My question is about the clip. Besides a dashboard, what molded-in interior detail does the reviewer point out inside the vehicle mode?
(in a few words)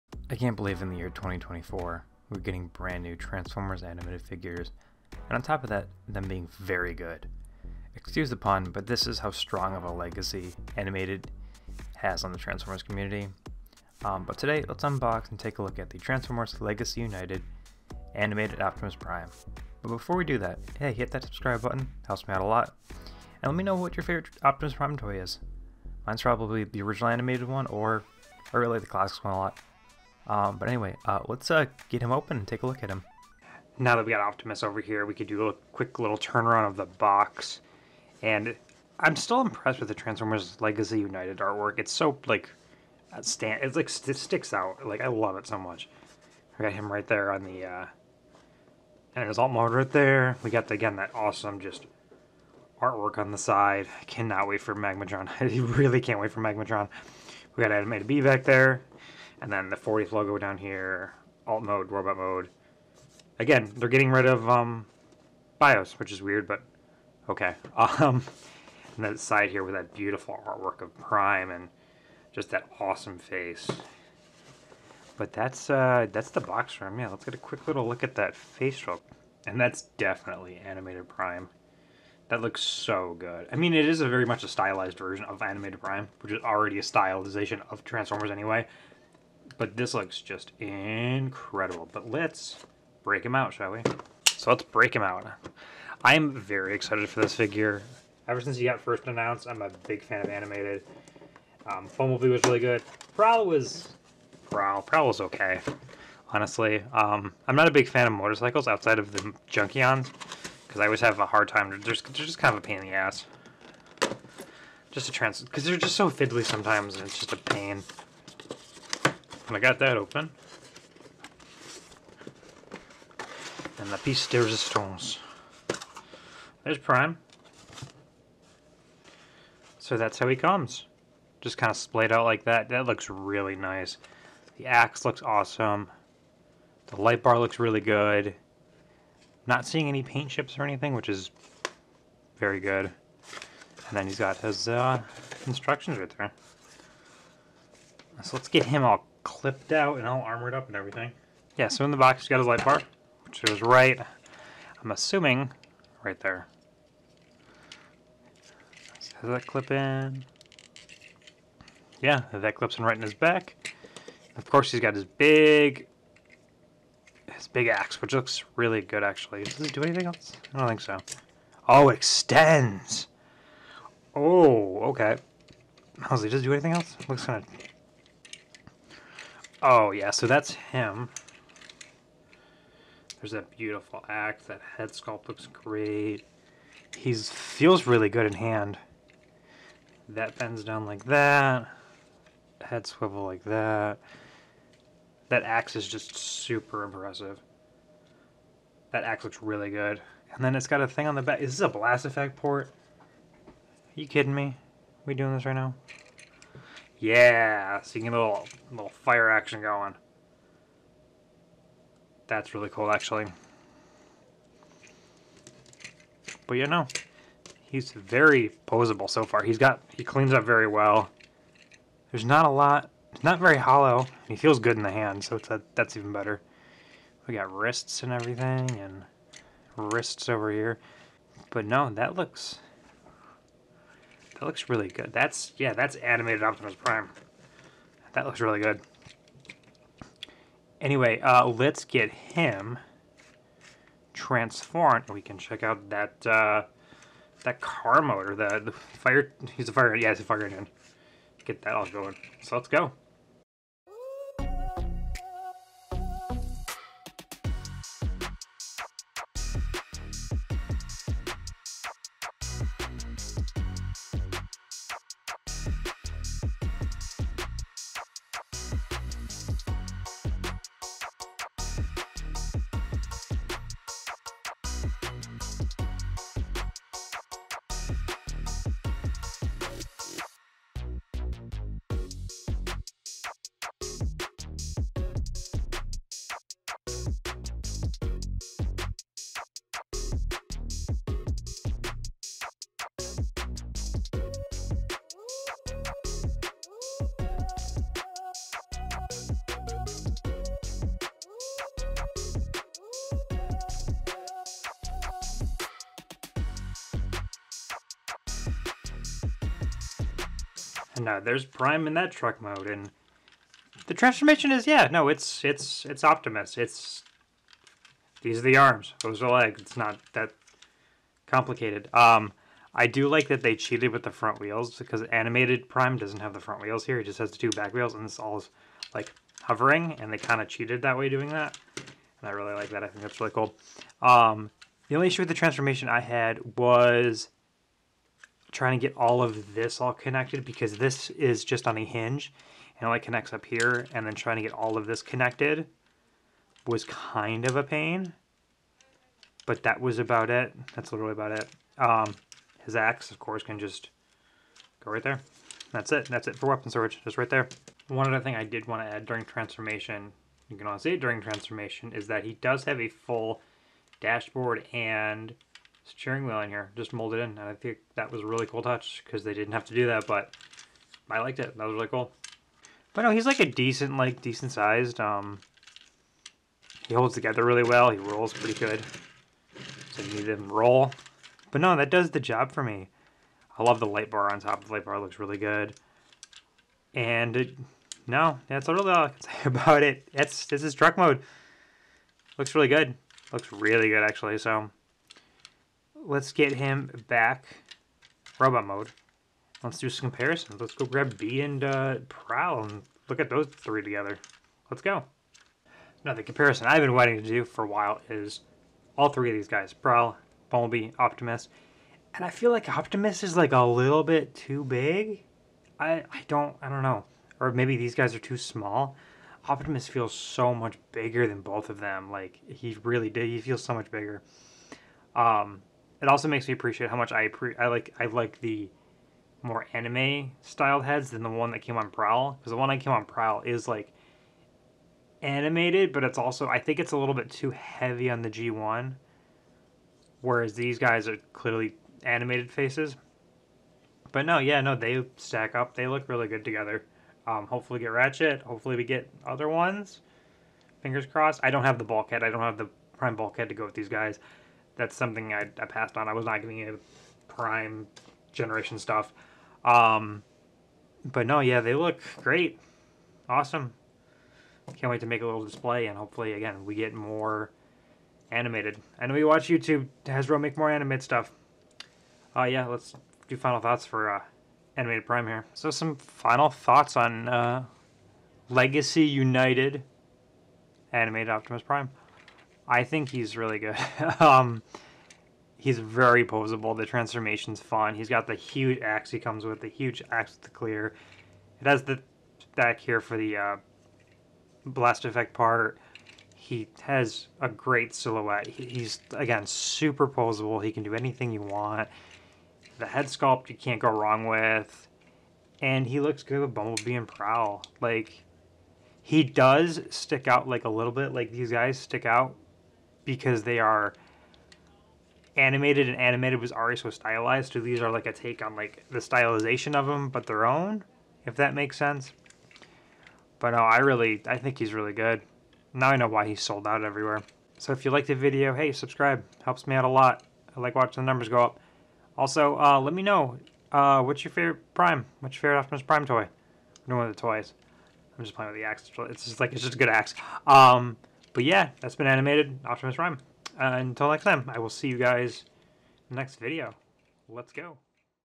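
steering wheel.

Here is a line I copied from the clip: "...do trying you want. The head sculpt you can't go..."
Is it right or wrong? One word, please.
wrong.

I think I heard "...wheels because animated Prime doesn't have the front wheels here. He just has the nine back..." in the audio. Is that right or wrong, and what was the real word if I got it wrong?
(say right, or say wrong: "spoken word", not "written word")
wrong: "two", not "nine".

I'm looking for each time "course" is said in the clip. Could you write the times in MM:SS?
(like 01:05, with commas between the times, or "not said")
02:44, 05:53.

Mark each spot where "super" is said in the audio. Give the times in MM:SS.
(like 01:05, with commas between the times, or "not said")
03:16, 08:19.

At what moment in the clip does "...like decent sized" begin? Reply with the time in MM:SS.
06:13.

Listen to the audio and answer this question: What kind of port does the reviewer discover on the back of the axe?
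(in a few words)
blast effect port.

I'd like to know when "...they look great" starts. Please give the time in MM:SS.
07:41.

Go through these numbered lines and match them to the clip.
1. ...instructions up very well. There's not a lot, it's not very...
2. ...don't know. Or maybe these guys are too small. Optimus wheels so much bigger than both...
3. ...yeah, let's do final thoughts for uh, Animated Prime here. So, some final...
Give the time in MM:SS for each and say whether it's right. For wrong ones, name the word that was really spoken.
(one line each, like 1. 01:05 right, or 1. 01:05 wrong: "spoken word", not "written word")
1. 03:40 wrong: "cleans", not "instructions"
2. 06:56 wrong: "feels", not "wheels"
3. 07:52 right.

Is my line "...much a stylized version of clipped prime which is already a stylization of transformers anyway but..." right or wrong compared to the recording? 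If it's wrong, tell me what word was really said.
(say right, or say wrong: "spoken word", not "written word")
wrong: "animated", not "clipped".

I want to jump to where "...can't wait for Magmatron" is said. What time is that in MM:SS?
00:56.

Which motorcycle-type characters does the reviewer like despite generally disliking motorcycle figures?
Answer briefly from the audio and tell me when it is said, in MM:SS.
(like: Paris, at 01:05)
Junkions, at 01:49.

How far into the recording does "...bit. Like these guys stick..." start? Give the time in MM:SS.
08:30.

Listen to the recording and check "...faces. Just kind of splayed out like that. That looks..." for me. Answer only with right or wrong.
wrong.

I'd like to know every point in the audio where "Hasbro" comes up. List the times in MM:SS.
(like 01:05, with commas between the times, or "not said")
07:50.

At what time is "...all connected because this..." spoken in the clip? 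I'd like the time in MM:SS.
05:39.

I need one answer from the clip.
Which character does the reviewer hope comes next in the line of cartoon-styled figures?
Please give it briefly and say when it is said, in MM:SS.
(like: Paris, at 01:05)
Ratchet, at 07:27.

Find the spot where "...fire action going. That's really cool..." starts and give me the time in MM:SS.
03:28.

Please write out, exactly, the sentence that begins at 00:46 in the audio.
We got him right there on the.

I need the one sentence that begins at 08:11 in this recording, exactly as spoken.
It has the back here for the uh, blast effect part.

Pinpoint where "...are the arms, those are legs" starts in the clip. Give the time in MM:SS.
05:18.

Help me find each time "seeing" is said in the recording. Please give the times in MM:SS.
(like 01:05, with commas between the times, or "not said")
02:19.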